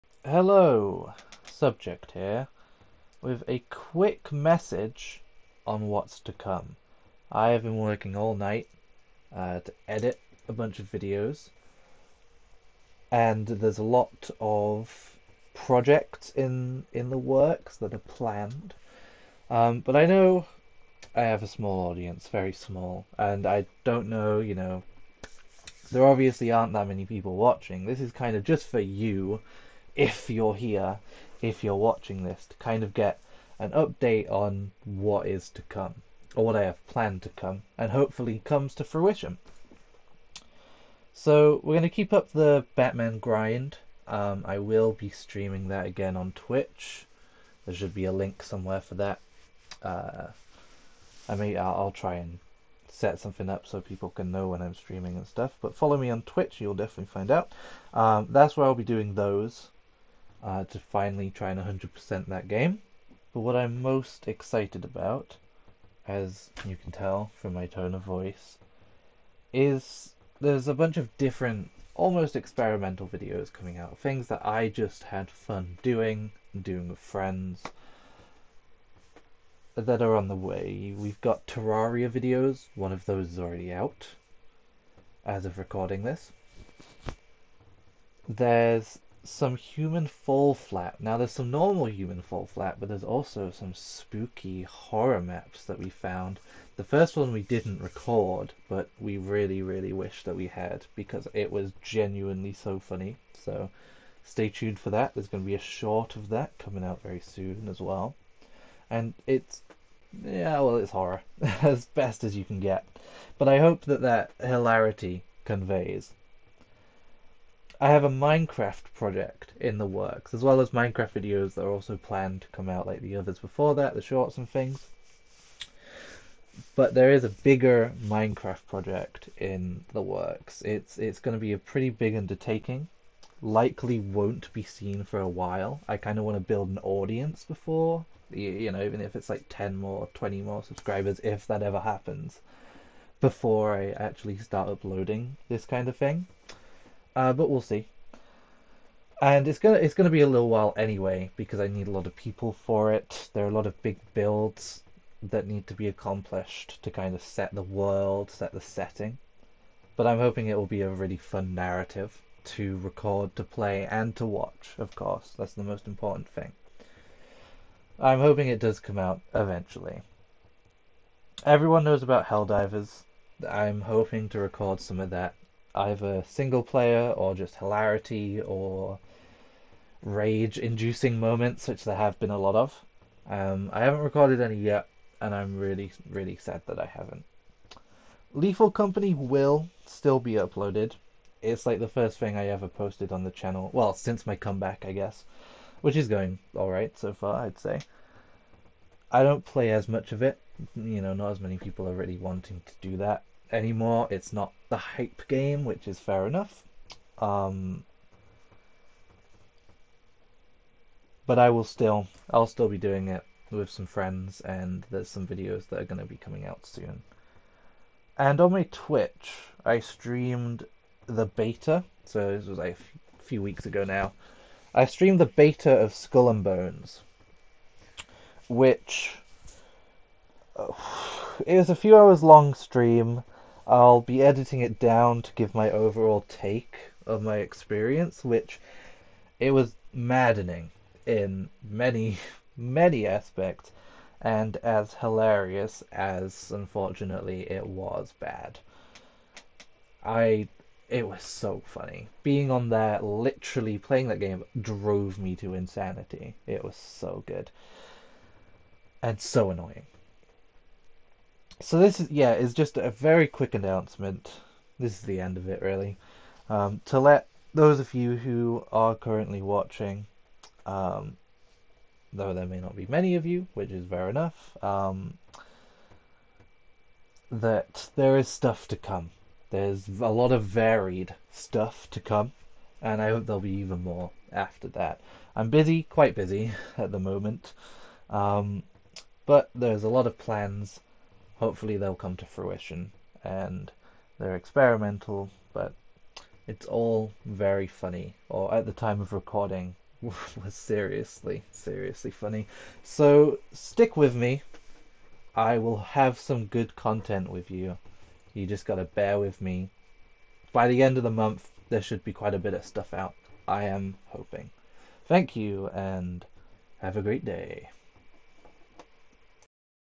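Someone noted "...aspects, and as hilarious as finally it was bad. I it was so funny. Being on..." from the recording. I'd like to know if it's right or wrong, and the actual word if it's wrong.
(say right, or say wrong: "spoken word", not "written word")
wrong: "unfortunately", not "finally".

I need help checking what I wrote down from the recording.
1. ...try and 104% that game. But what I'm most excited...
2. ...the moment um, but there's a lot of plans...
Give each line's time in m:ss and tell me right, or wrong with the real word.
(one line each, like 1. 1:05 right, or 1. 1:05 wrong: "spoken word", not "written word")
1. 1:01 wrong: "100", not "104"
2. 4:46 right.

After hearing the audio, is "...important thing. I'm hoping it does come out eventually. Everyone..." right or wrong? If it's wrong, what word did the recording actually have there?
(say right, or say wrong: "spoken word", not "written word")
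right.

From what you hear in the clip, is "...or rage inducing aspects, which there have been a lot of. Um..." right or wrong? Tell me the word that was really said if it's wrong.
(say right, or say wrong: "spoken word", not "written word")
wrong: "moments", not "aspects".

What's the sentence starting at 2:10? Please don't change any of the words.
It's it's going to be a pretty big undertaking.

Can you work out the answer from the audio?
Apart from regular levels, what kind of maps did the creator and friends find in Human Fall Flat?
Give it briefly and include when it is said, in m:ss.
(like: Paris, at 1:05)
spooky horror maps, at 1:33.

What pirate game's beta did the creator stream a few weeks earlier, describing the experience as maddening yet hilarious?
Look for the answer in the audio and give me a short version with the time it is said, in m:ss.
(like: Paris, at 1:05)
Skull and Bones, at 3:45.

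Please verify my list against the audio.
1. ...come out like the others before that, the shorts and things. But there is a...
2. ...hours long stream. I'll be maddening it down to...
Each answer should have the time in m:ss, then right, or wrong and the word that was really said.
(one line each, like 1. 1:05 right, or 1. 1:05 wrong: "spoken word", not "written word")
1. 2:02 right
2. 3:51 wrong: "editing", not "maddening".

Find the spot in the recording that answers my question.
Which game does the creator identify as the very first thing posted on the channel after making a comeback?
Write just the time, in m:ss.
3:08.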